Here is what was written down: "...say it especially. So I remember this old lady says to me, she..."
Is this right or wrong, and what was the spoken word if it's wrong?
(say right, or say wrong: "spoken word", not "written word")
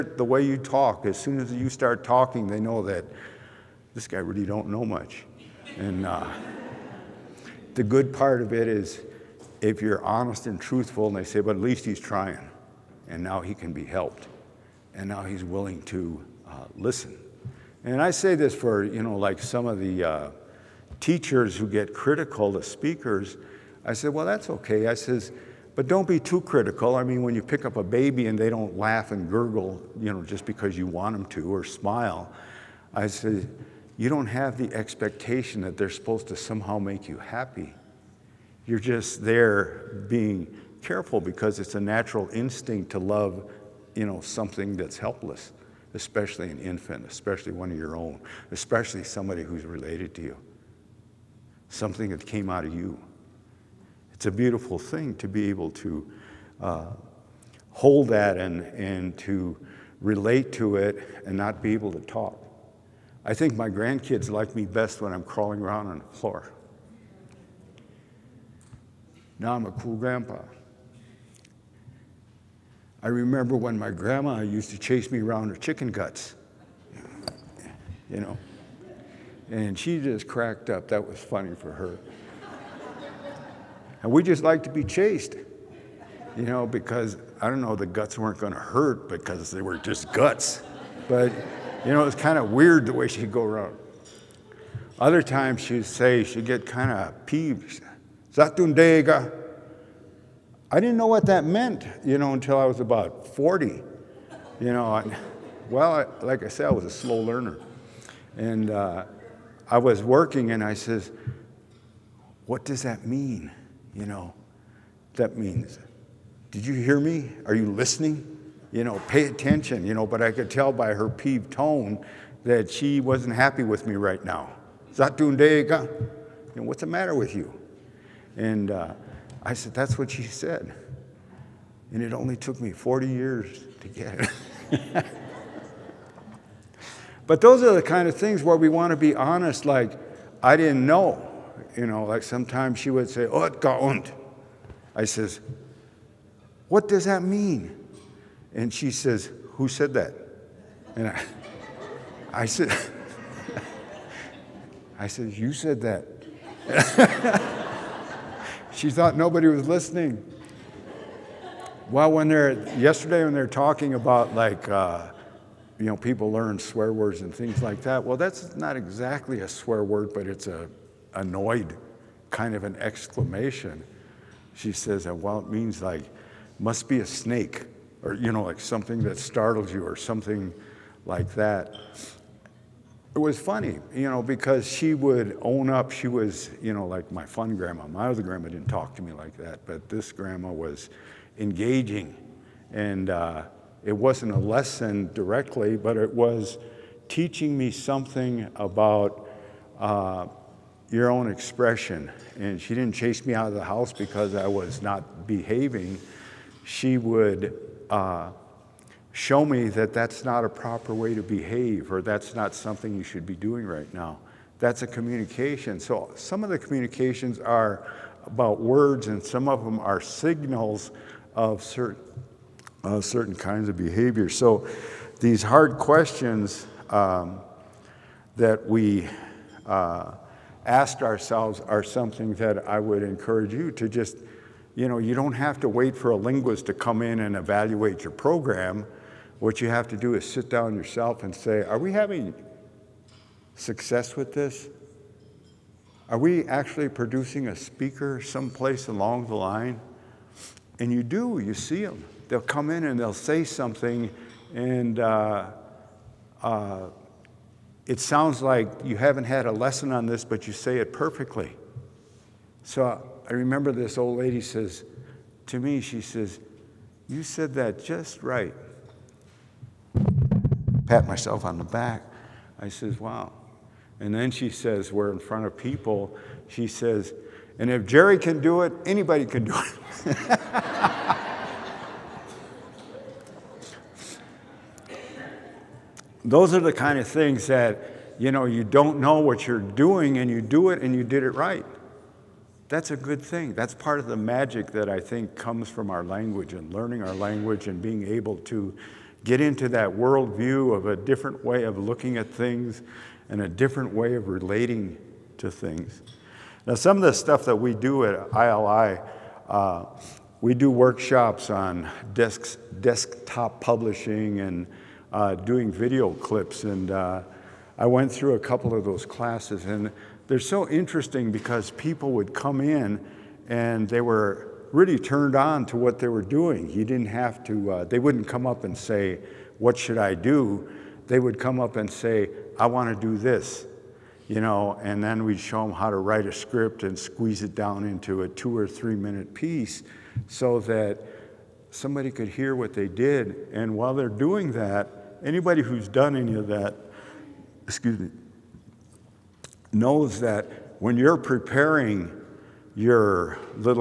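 wrong: "perfectly", not "especially".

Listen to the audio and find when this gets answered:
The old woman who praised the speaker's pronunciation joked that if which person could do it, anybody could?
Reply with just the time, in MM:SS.
04:37.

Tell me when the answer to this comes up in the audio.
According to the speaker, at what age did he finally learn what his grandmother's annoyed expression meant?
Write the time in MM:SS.
01:42.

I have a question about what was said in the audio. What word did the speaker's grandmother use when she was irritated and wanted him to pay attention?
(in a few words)
Zatundega.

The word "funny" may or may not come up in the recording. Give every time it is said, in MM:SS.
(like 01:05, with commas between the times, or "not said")
01:21, 03:03.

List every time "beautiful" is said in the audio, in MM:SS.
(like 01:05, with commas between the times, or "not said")
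00:54.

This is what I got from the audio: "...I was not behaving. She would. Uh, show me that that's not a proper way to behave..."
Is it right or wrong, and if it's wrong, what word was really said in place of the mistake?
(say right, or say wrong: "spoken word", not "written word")
right.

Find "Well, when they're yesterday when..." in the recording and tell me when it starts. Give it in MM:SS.
02:41.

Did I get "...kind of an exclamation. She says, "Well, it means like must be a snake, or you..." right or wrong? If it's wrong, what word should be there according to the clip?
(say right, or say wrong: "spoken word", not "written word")
right.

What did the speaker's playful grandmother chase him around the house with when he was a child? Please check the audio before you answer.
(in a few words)
chicken guts.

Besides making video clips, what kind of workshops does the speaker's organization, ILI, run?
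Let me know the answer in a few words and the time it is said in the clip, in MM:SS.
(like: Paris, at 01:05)
desktop publishing, at 05:12.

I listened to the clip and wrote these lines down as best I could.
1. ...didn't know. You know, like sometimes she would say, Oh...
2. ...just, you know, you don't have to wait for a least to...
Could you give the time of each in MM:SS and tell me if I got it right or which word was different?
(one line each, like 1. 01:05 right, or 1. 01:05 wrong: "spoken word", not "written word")
1. 02:20 right
2. 03:53 wrong: "linguist", not "least".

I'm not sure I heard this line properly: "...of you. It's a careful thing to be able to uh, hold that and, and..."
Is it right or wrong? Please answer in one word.
wrong.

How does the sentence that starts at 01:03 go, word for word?
I think my grandkids like me best when I'm crawling around on the floor.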